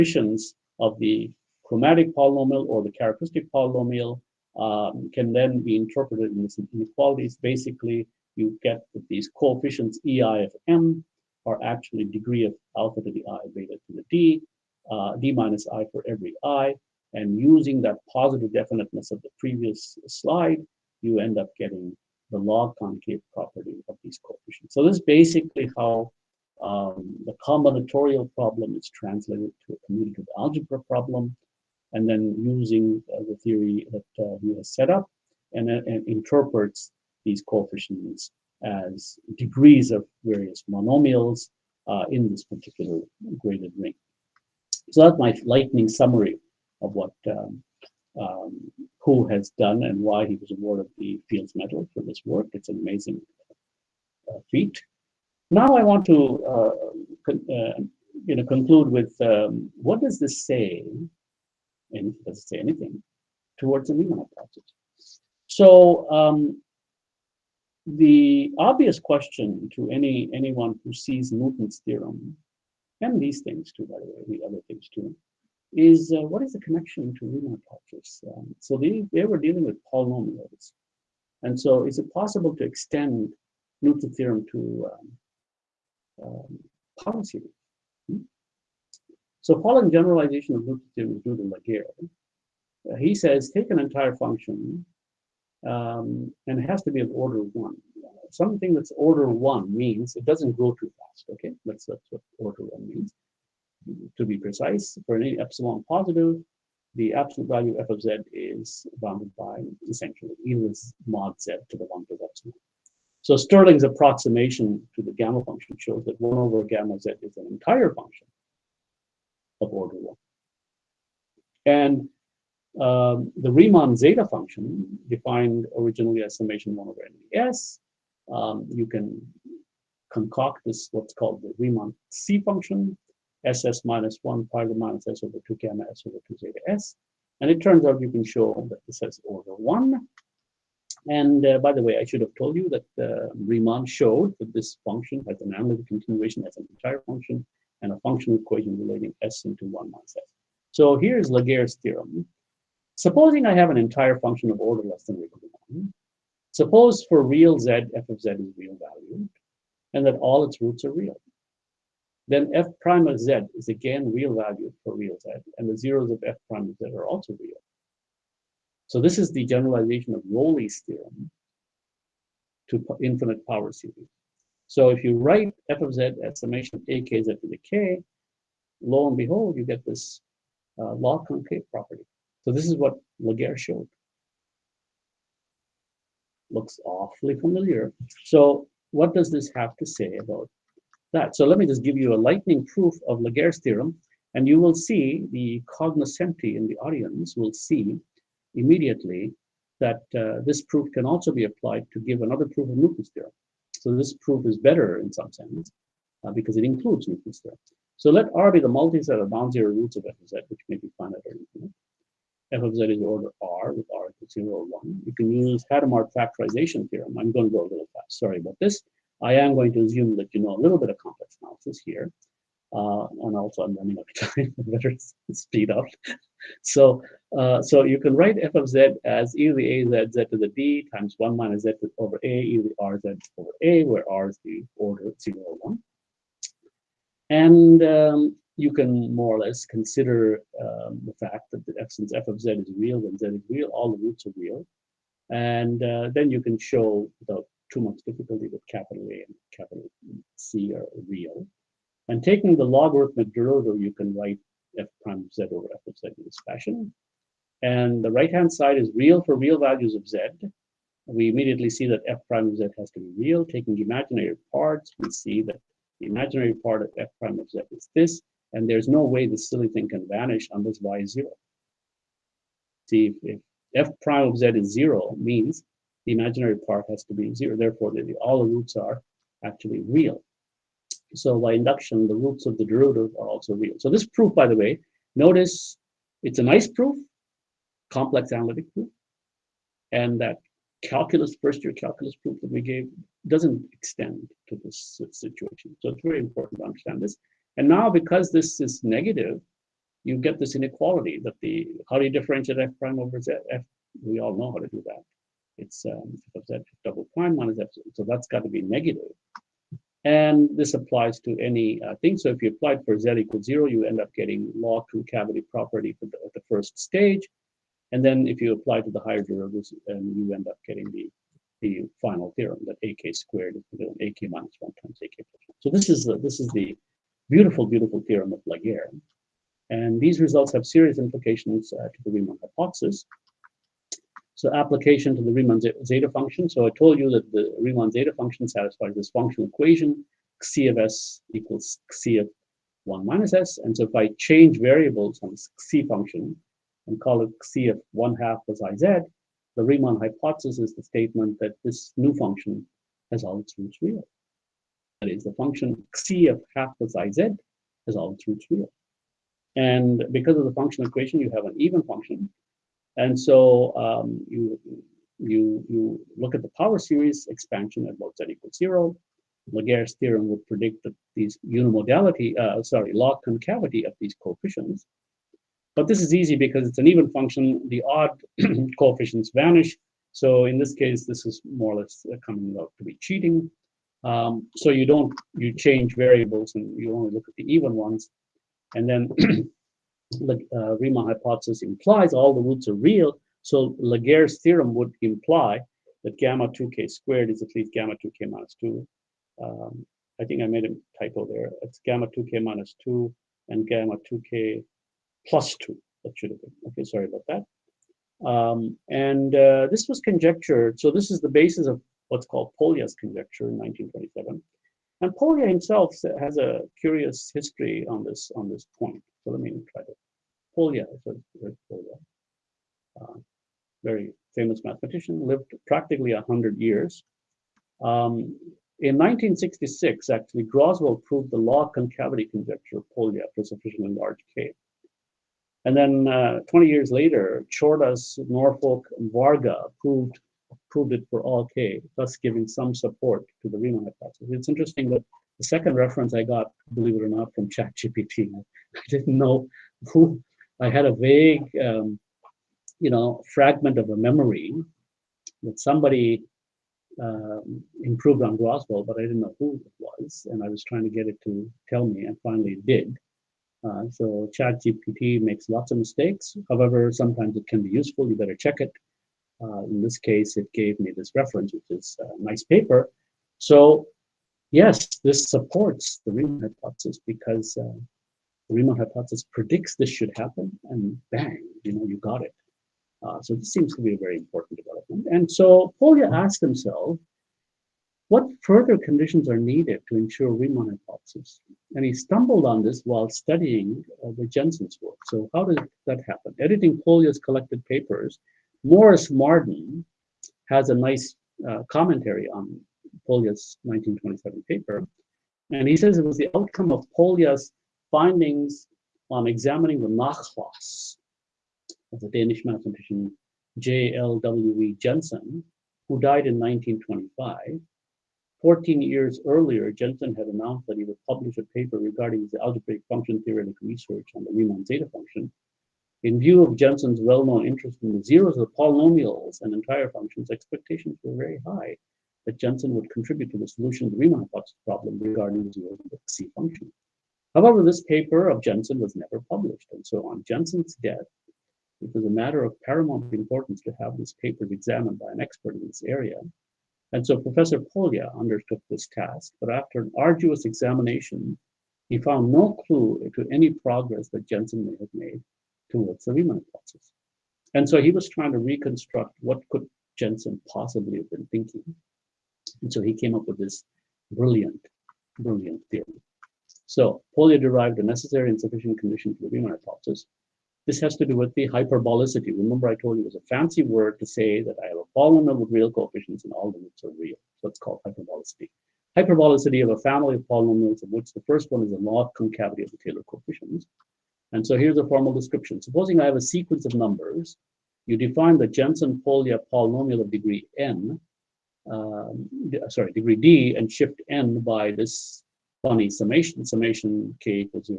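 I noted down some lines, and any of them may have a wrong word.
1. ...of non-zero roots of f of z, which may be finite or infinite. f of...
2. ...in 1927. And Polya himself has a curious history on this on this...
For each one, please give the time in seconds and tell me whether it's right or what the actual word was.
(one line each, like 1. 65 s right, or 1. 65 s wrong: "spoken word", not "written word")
1. 209 s right
2. 413 s right.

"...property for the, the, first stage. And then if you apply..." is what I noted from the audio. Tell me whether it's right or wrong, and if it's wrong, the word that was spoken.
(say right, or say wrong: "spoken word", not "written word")
right.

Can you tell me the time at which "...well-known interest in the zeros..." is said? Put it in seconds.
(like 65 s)
526 s.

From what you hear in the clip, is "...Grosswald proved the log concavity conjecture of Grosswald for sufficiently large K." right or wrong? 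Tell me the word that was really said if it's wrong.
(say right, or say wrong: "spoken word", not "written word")
wrong: "Polya", not "Grosswald".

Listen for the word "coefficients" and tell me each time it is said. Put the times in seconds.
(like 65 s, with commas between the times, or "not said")
9 s, 24 s, 37 s, 374 s, 378 s, 575 s, 583 s.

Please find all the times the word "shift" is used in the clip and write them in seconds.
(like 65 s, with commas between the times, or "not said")
593 s.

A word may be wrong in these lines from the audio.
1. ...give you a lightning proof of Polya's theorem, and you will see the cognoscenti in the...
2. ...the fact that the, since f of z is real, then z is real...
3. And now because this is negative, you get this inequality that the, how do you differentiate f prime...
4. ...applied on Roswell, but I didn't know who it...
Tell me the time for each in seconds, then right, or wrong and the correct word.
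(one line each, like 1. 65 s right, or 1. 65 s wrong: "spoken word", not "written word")
1. 191 s wrong: "Laguerre", not "Polya"
2. 241 s right
3. 297 s right
4. 457 s wrong: "improved", not "applied".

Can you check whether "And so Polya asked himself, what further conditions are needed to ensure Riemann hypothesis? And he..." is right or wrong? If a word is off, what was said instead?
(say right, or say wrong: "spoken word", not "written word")
right.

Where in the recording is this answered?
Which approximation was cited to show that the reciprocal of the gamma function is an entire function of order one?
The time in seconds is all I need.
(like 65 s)
113 s.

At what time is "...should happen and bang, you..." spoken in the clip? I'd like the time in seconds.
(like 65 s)
479 s.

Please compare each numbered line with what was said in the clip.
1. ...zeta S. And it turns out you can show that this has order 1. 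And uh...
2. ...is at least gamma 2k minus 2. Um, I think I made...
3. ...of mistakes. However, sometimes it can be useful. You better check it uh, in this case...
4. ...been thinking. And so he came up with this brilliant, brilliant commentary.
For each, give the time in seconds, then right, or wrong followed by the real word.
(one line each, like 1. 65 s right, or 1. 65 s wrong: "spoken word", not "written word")
1. 136 s right
2. 397 s right
3. 465 s right
4. 561 s wrong: "theory", not "commentary".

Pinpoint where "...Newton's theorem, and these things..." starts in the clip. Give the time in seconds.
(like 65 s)
71 s.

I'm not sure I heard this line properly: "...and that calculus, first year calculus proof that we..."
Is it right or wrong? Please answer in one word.
right.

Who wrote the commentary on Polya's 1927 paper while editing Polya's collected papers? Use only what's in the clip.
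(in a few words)
Morris Marden.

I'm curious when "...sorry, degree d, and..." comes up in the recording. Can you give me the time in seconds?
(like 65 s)
592 s.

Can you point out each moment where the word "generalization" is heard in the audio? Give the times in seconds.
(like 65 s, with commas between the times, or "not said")
89 s, 169 s.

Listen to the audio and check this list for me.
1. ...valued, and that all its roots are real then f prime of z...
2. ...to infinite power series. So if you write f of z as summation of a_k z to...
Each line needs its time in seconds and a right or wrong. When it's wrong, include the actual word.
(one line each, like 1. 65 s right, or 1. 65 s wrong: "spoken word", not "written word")
1. 158 s right
2. 172 s right.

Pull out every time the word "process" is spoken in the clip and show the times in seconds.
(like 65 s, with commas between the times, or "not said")
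64 s, 556 s.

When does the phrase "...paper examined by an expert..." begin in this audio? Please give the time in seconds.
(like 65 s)
544 s.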